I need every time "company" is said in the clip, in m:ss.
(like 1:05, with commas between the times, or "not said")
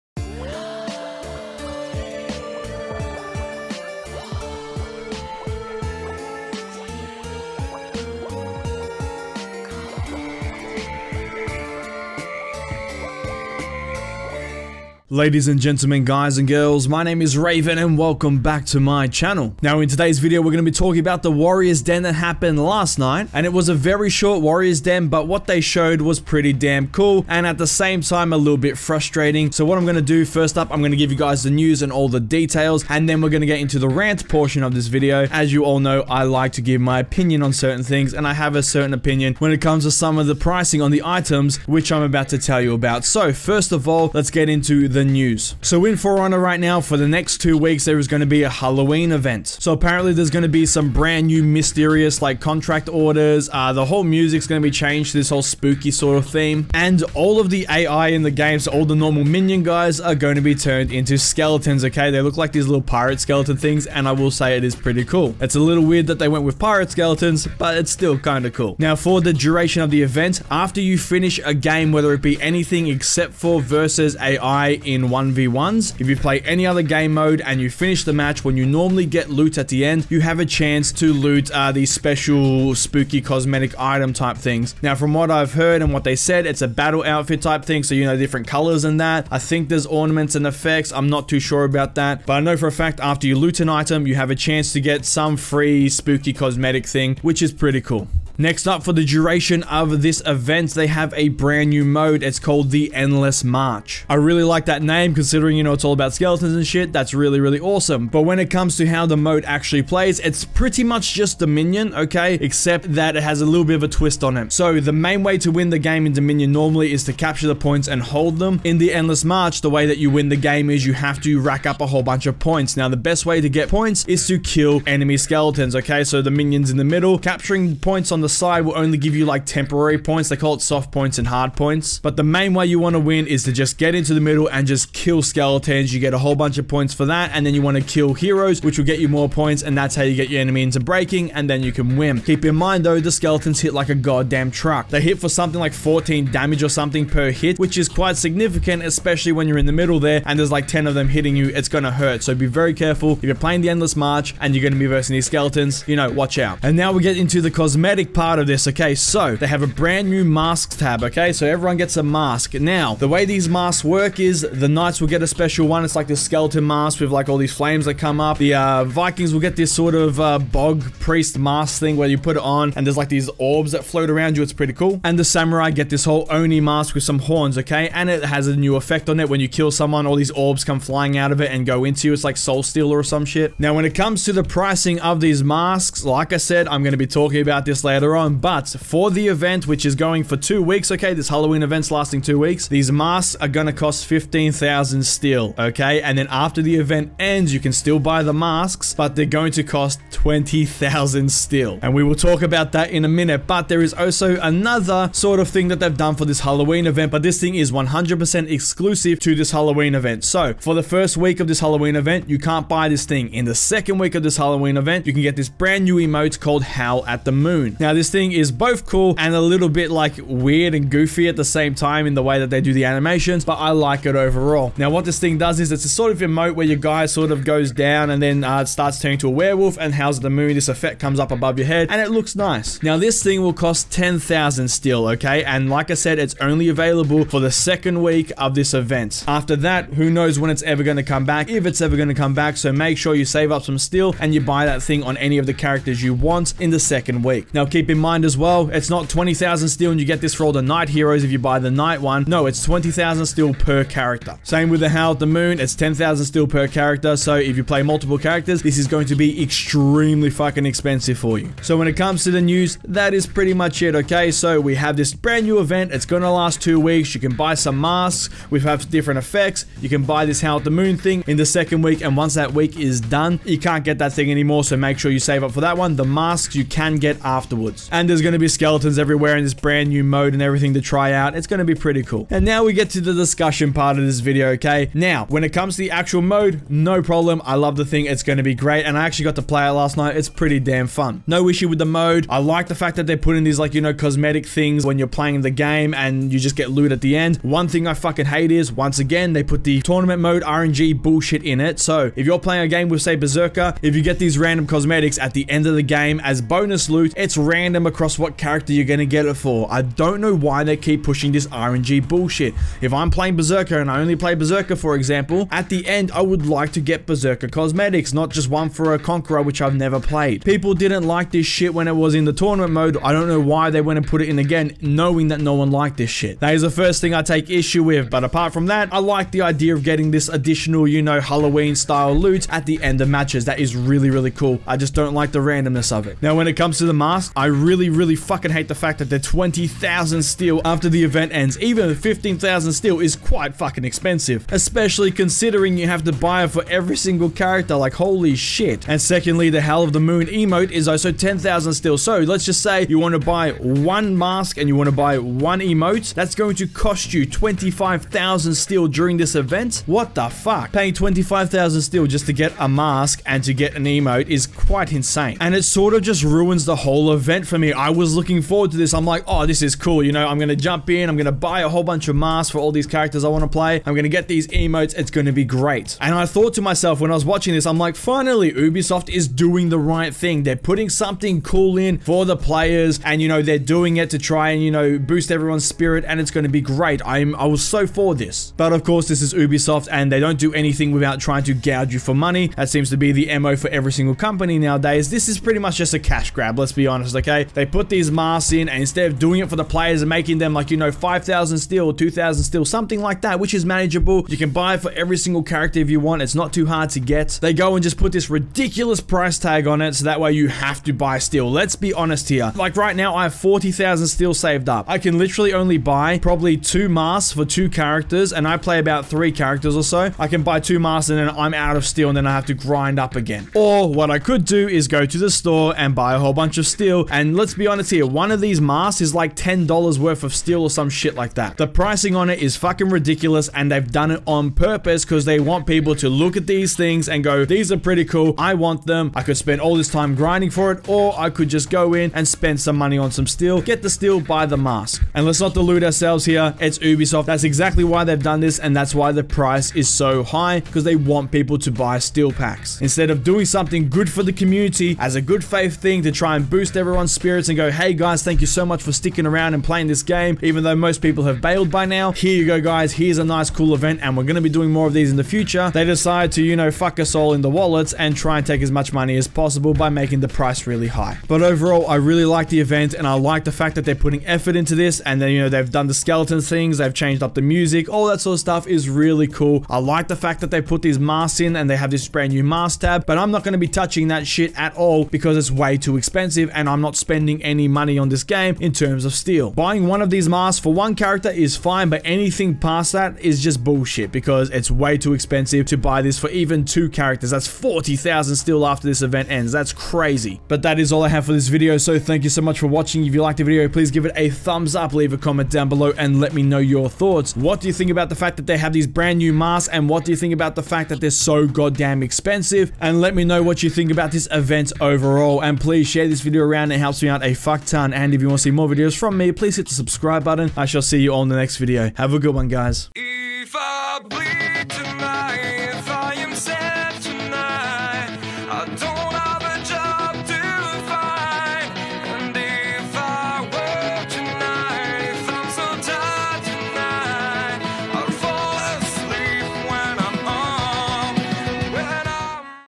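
6:34.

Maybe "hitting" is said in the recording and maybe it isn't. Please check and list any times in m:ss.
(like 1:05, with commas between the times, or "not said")
2:31.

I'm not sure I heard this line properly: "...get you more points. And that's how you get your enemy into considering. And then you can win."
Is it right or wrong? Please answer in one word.
wrong.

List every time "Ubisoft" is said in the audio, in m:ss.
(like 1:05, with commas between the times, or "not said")
6:18, 6:29, 7:26.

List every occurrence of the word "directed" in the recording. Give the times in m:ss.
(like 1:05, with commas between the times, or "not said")
not said.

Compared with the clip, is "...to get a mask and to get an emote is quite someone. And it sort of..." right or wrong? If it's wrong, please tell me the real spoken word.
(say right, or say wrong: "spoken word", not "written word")
wrong: "insane", not "someone".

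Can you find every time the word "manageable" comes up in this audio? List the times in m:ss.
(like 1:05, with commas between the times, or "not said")
6:43.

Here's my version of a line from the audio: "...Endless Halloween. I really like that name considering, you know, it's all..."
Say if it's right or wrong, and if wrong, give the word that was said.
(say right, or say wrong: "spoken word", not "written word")
wrong: "March", not "Halloween".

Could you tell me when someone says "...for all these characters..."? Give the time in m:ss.
6:12.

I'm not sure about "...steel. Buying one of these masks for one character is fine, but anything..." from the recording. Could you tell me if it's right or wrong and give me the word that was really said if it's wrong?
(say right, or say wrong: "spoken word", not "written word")
right.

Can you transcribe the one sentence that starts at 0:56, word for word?
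And all of the AI in the game, so all the normal minion guys are going to be turned into skeletons, okay?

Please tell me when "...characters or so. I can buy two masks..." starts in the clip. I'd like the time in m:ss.
6:59.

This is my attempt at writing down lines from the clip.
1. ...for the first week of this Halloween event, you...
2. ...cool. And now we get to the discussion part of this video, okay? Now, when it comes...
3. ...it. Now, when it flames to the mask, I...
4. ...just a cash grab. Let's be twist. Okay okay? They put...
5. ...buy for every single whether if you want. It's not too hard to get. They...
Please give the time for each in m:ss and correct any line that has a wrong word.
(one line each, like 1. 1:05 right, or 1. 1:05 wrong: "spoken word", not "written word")
1. 3:30 right
2. 4:42 right
3. 5:36 wrong: "comes", not "flames"
4. 6:35 wrong: "honest", not "twist"
5. 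6:44 wrong: "character", not "whether".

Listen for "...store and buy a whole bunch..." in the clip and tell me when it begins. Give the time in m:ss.
7:05.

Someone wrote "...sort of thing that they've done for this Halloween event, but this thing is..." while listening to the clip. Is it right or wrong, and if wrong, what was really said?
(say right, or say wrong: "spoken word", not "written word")
right.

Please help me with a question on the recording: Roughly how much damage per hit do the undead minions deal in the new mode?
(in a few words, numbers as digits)
14.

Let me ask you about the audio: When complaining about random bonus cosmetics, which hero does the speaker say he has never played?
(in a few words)
Conqueror.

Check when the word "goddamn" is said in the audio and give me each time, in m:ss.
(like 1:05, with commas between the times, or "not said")
2:23, 8:31.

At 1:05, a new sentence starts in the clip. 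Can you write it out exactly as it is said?
It's a little weird that they went with pirate skeletons, but it's still kind of cool.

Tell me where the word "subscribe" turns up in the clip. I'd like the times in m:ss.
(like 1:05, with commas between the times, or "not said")
8:39.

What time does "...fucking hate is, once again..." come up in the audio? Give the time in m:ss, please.
4:57.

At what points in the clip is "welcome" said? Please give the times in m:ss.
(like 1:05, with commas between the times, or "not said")
0:17.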